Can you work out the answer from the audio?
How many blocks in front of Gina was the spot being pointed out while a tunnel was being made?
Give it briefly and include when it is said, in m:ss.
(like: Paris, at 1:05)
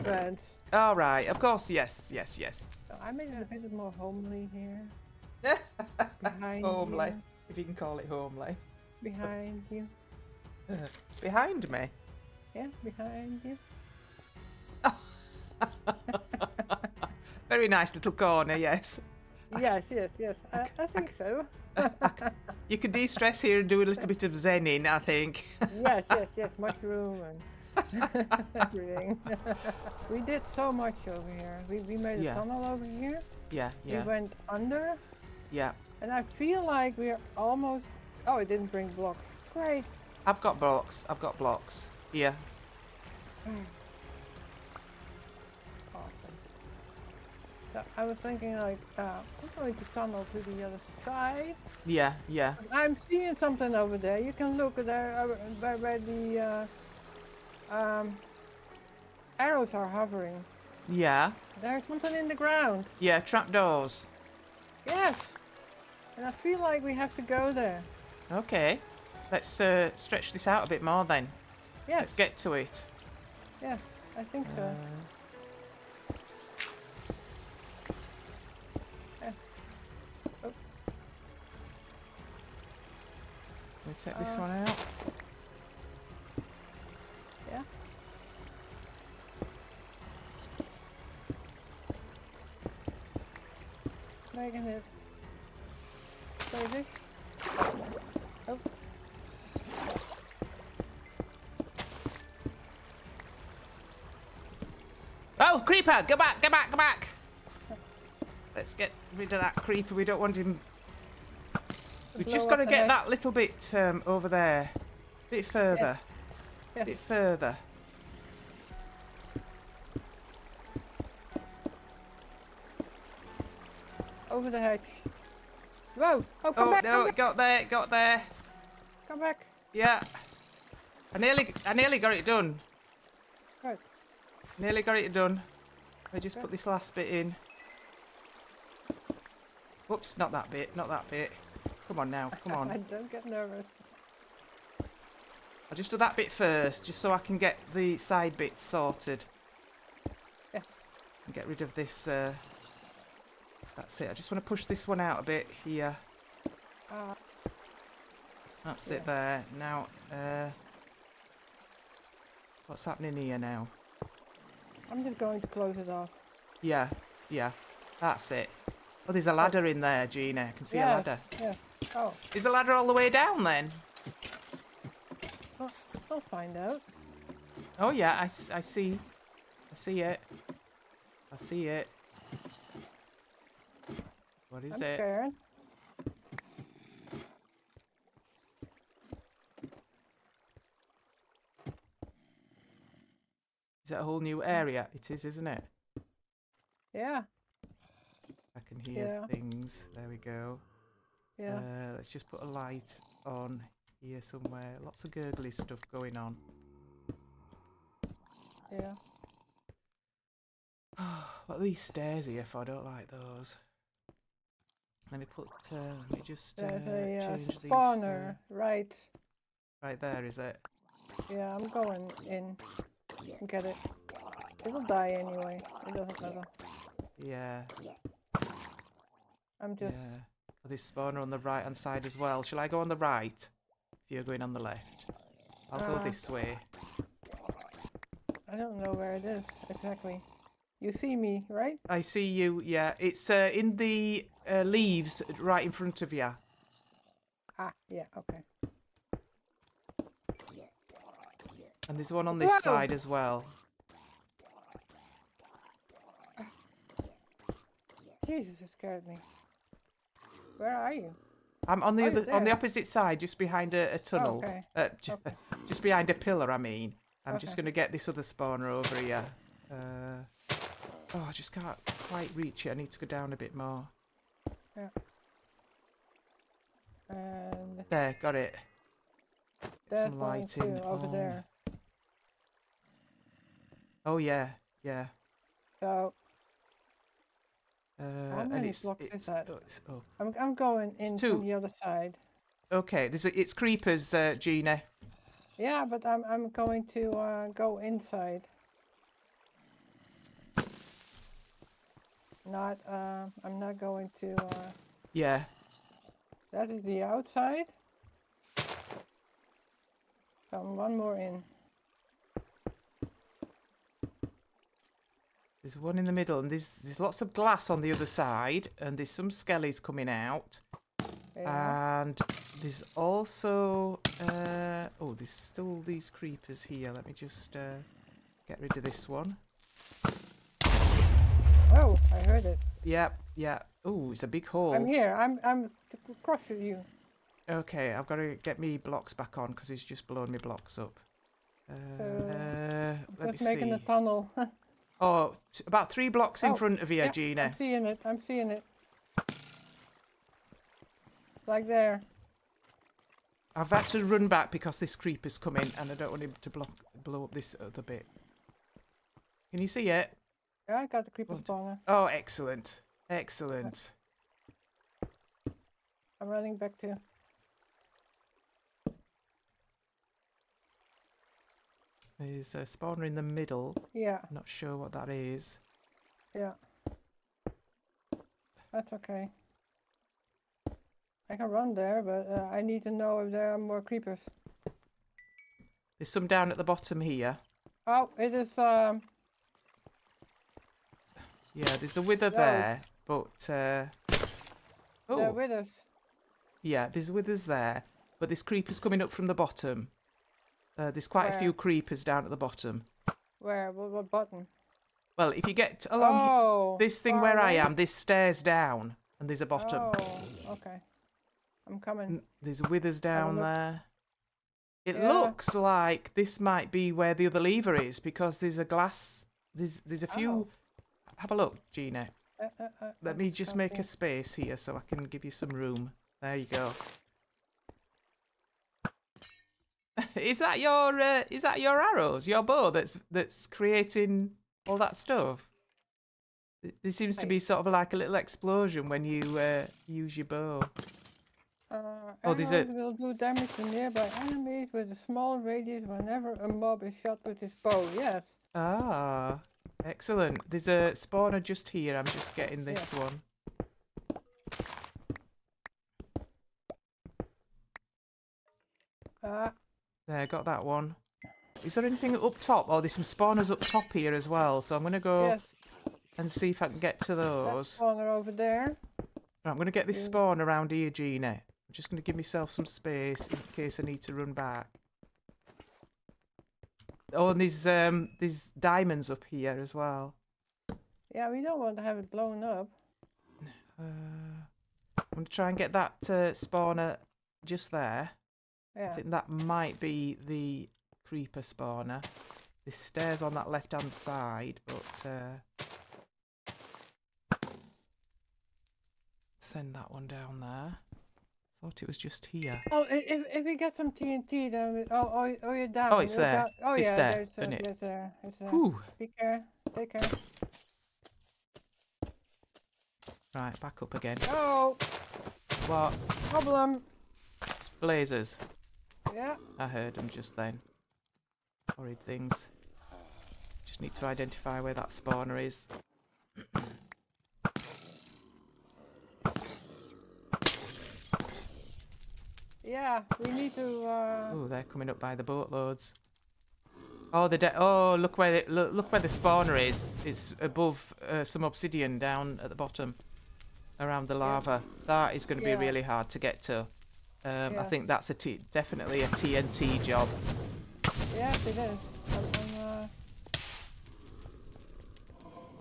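3, at 5:45.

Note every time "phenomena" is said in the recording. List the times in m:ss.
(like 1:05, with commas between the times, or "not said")
not said.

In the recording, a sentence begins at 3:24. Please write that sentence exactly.
Lots of gurgly stuff going on.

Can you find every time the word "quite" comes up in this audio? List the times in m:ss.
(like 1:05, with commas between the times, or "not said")
4:32, 6:41.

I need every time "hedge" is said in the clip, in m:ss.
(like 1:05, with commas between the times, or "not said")
2:04.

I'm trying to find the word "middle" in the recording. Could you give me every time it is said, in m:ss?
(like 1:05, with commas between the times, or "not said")
5:16, 6:13.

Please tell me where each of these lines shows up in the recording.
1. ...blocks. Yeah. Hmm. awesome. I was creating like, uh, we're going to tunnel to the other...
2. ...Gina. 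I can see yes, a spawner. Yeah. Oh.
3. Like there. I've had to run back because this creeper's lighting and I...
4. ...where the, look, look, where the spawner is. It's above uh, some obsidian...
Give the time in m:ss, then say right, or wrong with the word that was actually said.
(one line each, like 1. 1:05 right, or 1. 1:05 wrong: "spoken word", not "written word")
1. 0:41 wrong: "thinking", not "creating"
2. 2:50 wrong: "ladder", not "spawner"
3. 5:51 wrong: "coming", not "lighting"
4. 8:58 right.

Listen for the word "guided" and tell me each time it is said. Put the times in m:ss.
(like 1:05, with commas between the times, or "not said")
not said.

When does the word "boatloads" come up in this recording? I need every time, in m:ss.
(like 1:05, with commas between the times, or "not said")
8:55.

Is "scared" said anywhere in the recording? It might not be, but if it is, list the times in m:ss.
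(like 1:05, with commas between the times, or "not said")
3:04, 4:18.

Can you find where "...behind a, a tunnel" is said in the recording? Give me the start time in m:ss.
4:23.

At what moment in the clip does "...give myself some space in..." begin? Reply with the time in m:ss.
7:52.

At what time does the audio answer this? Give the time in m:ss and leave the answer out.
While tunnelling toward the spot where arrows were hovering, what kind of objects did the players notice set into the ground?
1:03.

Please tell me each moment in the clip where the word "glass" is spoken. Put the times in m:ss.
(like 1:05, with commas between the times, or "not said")
5:17, 6:58.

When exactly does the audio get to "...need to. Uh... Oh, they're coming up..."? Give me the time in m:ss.
8:53.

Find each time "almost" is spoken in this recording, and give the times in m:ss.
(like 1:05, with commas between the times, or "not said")
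0:37.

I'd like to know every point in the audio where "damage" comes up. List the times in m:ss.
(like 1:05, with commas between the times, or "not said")
7:23.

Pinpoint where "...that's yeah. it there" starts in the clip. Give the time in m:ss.
2:38.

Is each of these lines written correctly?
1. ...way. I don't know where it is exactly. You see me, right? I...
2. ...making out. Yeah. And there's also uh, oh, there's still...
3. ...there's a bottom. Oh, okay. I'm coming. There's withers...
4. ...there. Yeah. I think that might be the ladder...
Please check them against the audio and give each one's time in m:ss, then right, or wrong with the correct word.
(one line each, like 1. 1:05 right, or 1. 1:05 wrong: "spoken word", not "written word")
1. 3:56 right
2. 5:19 wrong: "coming", not "making"
3. 6:49 right
4. 8:07 wrong: "creeper", not "ladder".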